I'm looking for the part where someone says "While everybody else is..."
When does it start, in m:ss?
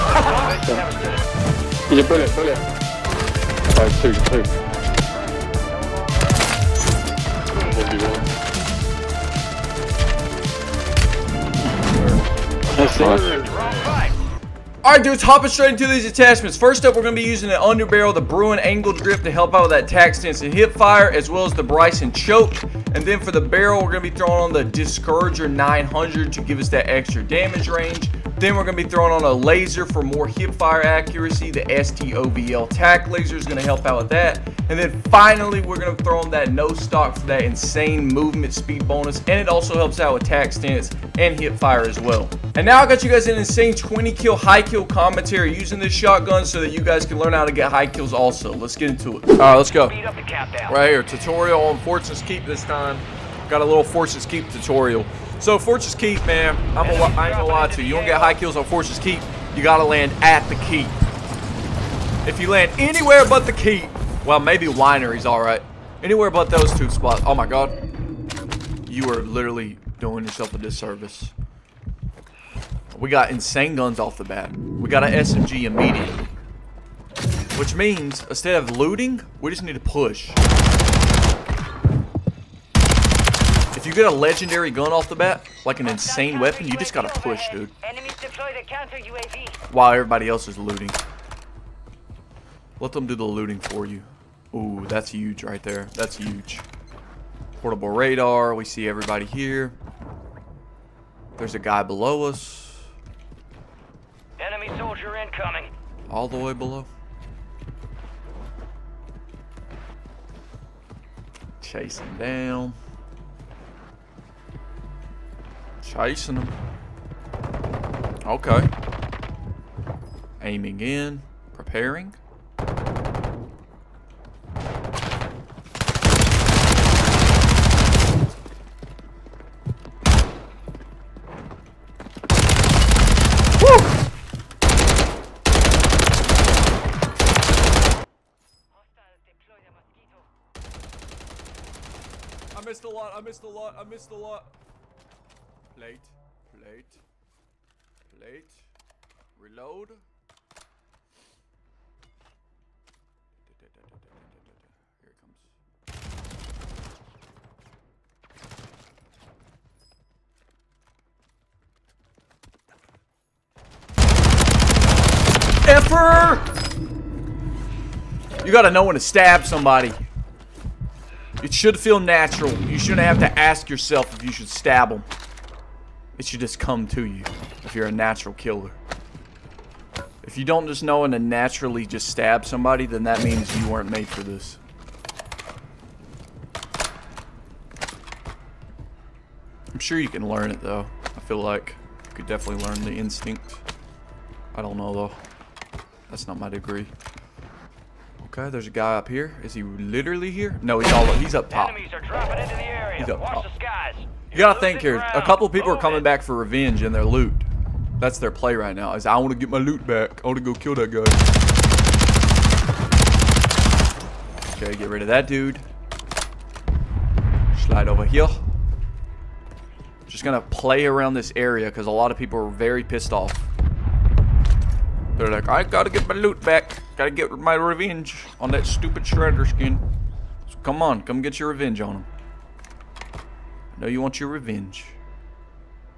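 1:29.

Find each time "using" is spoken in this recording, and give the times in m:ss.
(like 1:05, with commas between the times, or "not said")
0:17, 0:45.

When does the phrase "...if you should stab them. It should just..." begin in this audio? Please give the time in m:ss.
2:54.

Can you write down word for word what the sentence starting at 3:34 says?
Okay, get rid of that dude.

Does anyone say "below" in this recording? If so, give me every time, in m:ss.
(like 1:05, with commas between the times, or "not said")
1:41, 1:46.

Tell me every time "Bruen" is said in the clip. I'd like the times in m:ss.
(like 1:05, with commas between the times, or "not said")
0:18.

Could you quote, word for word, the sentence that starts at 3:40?
Just gonna play around this area because a lot of people are very pissed off.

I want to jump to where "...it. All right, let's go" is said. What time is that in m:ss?
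0:49.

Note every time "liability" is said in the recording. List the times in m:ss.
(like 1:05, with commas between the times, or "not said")
not said.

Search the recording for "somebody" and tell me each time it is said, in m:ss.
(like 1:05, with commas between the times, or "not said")
2:49, 3:02.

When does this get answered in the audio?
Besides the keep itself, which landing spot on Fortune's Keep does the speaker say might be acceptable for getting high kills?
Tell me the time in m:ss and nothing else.
1:04.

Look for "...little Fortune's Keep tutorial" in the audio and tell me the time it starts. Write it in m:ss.
0:53.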